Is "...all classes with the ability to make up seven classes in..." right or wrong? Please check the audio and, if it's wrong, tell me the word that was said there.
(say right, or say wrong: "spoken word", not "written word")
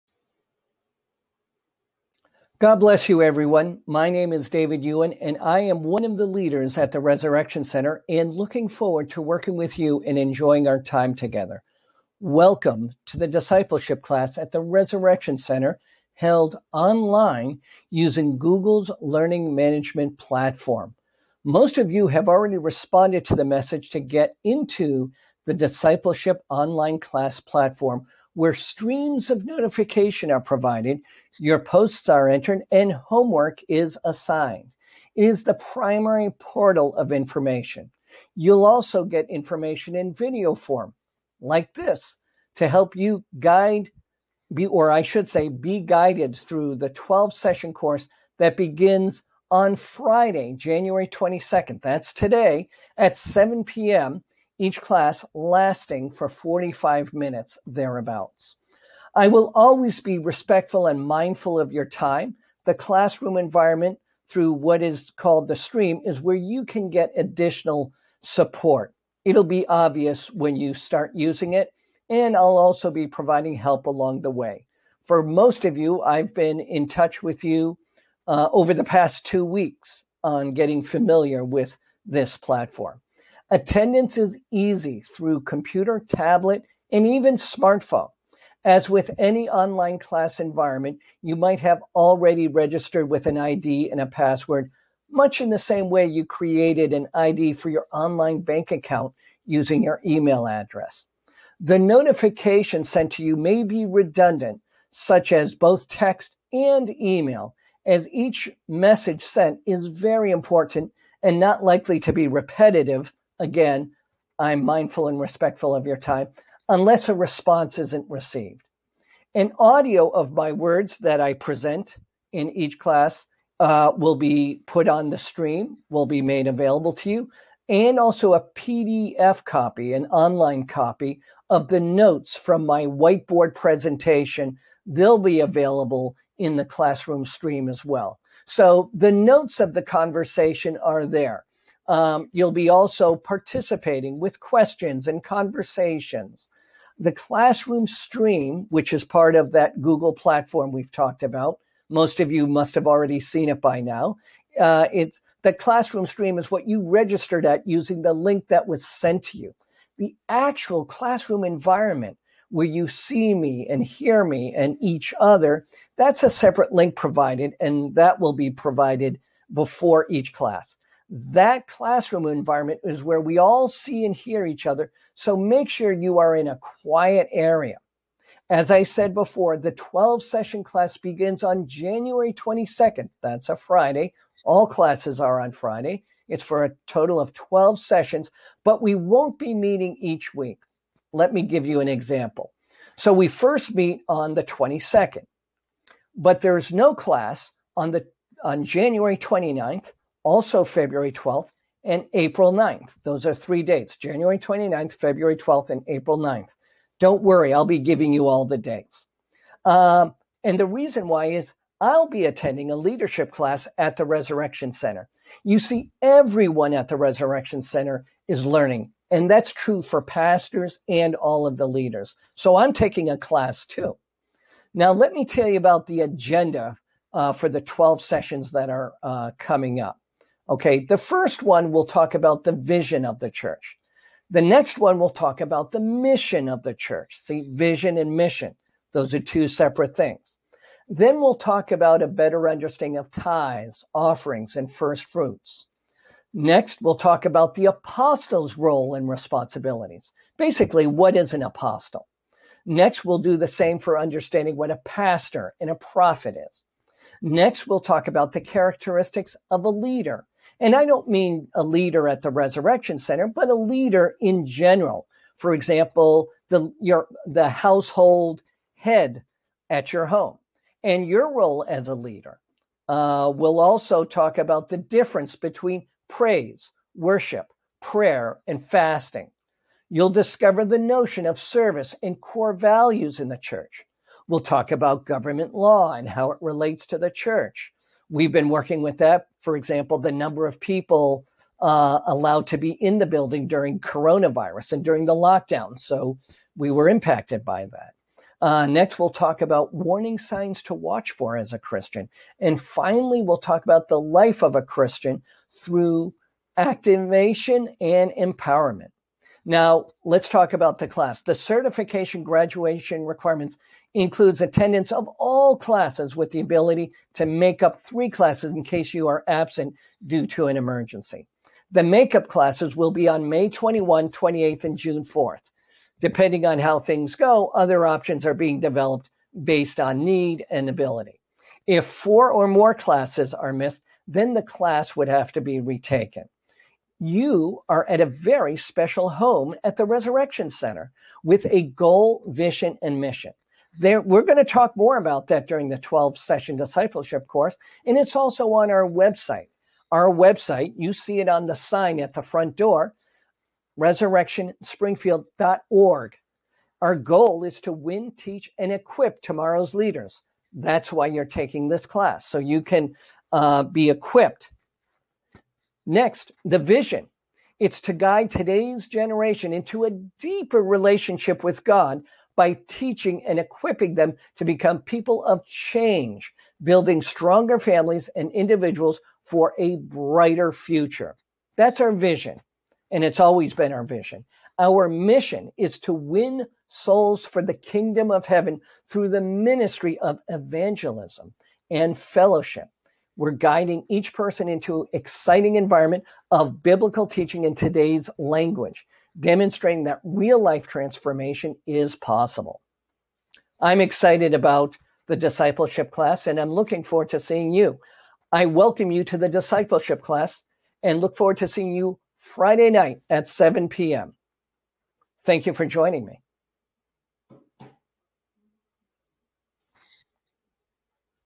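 wrong: "three", not "seven".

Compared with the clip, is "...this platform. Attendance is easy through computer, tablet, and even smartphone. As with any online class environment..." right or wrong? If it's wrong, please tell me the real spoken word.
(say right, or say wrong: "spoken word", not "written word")
right.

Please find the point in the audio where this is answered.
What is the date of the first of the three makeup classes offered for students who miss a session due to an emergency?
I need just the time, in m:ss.
5:23.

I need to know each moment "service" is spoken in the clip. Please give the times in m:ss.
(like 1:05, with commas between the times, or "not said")
4:41.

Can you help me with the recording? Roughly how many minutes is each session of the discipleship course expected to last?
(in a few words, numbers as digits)
45 minutes.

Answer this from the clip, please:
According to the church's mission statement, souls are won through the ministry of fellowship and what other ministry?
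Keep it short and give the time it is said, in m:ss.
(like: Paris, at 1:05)
evangelism, at 6:30.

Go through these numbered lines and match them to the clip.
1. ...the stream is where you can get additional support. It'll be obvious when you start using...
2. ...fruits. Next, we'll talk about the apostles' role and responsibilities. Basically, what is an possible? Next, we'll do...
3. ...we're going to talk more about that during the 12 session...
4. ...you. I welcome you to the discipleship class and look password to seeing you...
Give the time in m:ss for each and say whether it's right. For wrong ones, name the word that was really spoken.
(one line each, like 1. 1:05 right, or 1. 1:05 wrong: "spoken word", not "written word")
1. 1:05 right
2. 4:05 wrong: "apostle", not "possible"
3. 5:44 right
4. 6:47 wrong: "forward", not "password".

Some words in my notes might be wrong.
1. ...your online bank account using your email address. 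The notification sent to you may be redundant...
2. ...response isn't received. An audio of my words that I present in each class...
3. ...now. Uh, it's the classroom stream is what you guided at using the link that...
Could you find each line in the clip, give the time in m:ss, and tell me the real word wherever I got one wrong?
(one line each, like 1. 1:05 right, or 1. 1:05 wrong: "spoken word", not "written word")
1. 1:37 right
2. 1:57 right
3. 2:33 wrong: "registered", not "guided".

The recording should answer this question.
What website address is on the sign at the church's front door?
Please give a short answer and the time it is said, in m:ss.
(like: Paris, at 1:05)
resurrectionspringfield.org, at 5:53.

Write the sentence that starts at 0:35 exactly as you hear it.
It is the primary portal of information.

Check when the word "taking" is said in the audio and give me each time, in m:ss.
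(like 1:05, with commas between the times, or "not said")
3:42, 6:01.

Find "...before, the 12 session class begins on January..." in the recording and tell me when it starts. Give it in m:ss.
2:59.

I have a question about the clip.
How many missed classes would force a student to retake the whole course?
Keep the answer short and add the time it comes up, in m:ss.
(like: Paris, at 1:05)
4, at 5:31.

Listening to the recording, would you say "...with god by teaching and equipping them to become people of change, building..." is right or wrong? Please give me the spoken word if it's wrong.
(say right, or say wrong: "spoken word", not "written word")
right.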